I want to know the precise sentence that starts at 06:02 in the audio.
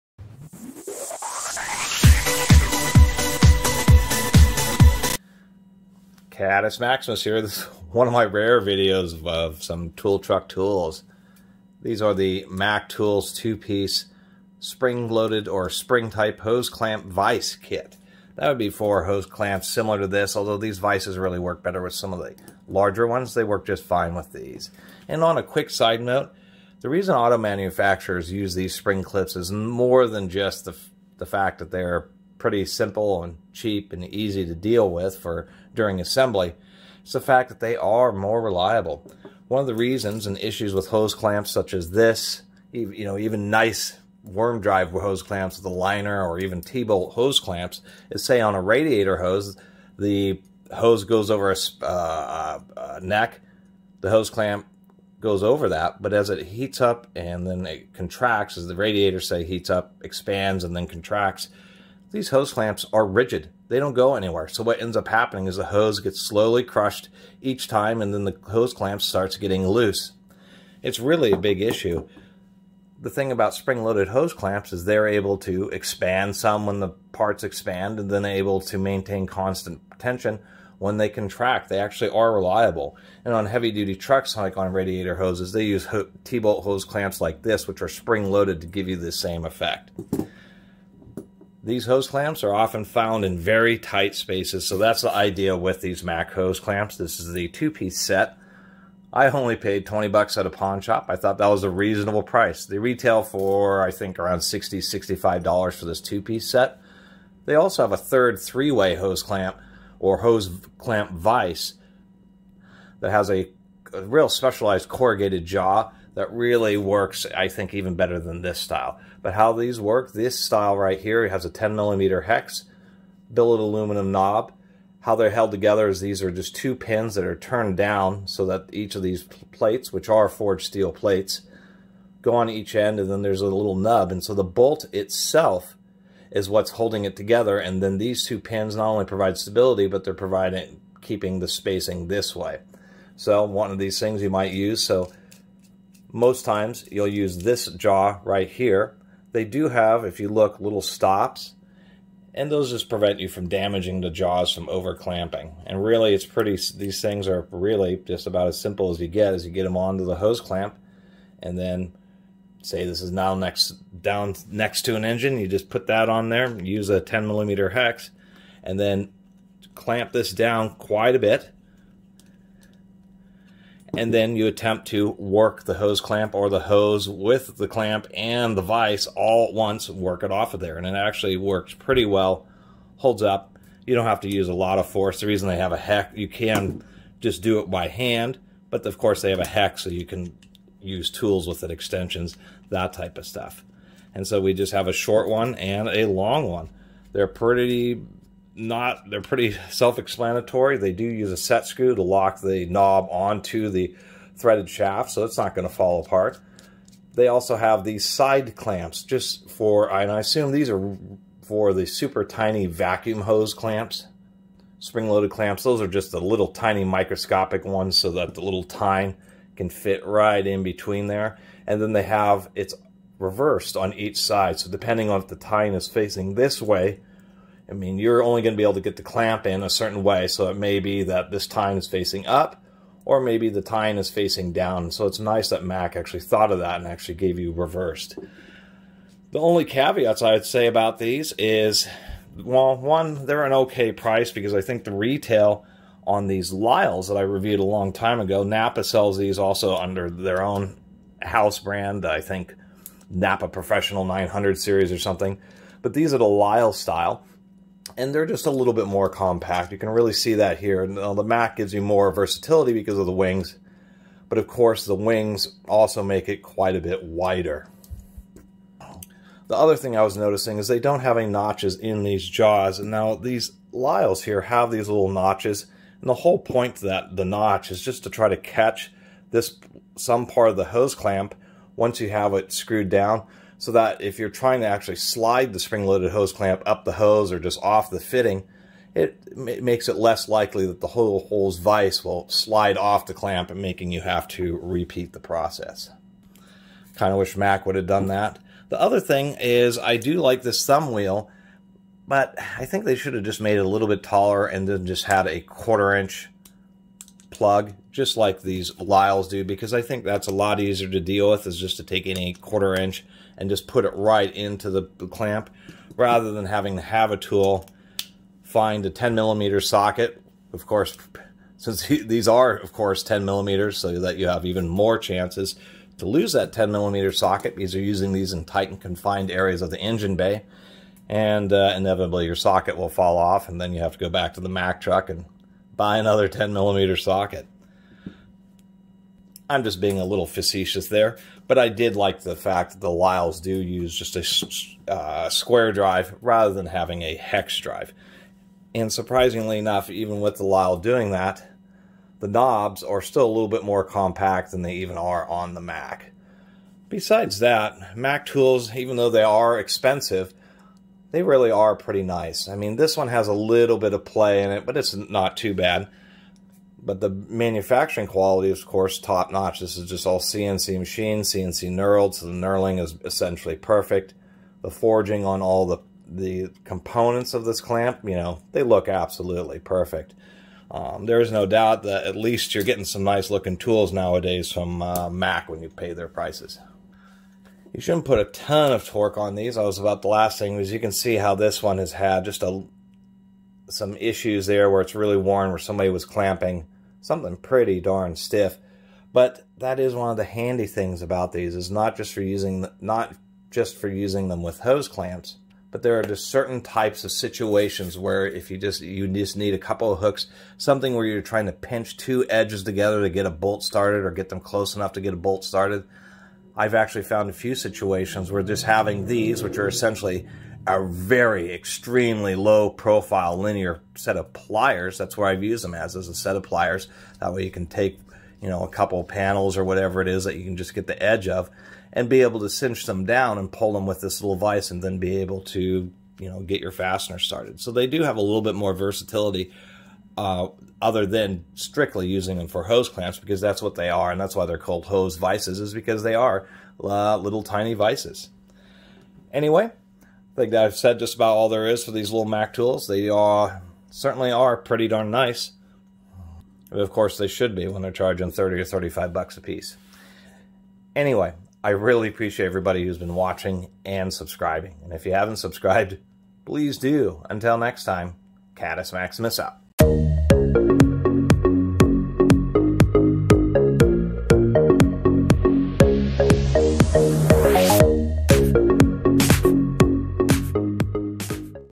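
I mean, this one has a little bit of play in it, but it's not too bad.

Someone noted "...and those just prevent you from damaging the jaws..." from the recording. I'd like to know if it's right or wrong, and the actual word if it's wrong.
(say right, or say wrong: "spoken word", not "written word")
right.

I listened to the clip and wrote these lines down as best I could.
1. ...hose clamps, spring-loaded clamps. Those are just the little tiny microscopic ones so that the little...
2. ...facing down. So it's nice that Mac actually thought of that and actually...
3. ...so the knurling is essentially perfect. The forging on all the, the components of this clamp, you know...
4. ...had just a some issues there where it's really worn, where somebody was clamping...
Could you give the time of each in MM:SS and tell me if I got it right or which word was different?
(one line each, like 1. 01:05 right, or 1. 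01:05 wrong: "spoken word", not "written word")
1. 03:33 right
2. 03:54 right
3. 06:12 right
4. 06:31 right.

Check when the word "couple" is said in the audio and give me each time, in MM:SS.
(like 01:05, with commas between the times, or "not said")
06:49, 07:08.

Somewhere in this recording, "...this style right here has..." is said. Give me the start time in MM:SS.
02:00.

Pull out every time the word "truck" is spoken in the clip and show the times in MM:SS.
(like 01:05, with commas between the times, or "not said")
00:10, 01:23, 05:34.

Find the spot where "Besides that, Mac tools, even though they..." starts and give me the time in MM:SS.
05:56.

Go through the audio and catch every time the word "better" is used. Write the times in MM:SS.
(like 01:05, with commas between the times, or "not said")
00:21, 01:57.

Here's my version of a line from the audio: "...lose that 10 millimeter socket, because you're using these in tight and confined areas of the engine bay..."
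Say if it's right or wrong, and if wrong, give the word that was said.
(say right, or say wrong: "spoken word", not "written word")
right.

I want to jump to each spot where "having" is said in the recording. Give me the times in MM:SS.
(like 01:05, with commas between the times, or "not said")
05:16, 05:46, 06:58.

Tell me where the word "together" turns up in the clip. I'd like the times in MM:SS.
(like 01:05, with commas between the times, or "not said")
02:05, 02:17, 06:52.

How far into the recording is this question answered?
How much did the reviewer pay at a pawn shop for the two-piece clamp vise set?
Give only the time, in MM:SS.
01:39.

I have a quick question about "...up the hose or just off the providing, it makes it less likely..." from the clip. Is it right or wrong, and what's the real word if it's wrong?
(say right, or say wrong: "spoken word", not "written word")
wrong: "fitting", not "providing".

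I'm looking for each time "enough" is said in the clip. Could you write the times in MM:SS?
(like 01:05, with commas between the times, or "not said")
05:49, 06:54.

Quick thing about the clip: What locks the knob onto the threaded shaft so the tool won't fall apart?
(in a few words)
set screw.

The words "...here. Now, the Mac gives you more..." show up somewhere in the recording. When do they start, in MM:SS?
04:20.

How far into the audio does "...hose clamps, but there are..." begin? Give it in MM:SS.
06:44.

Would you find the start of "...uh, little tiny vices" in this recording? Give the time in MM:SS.
07:26.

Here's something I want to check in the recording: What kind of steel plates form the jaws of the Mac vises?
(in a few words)
forged steel.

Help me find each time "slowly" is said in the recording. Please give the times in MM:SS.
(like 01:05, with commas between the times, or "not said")
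01:06.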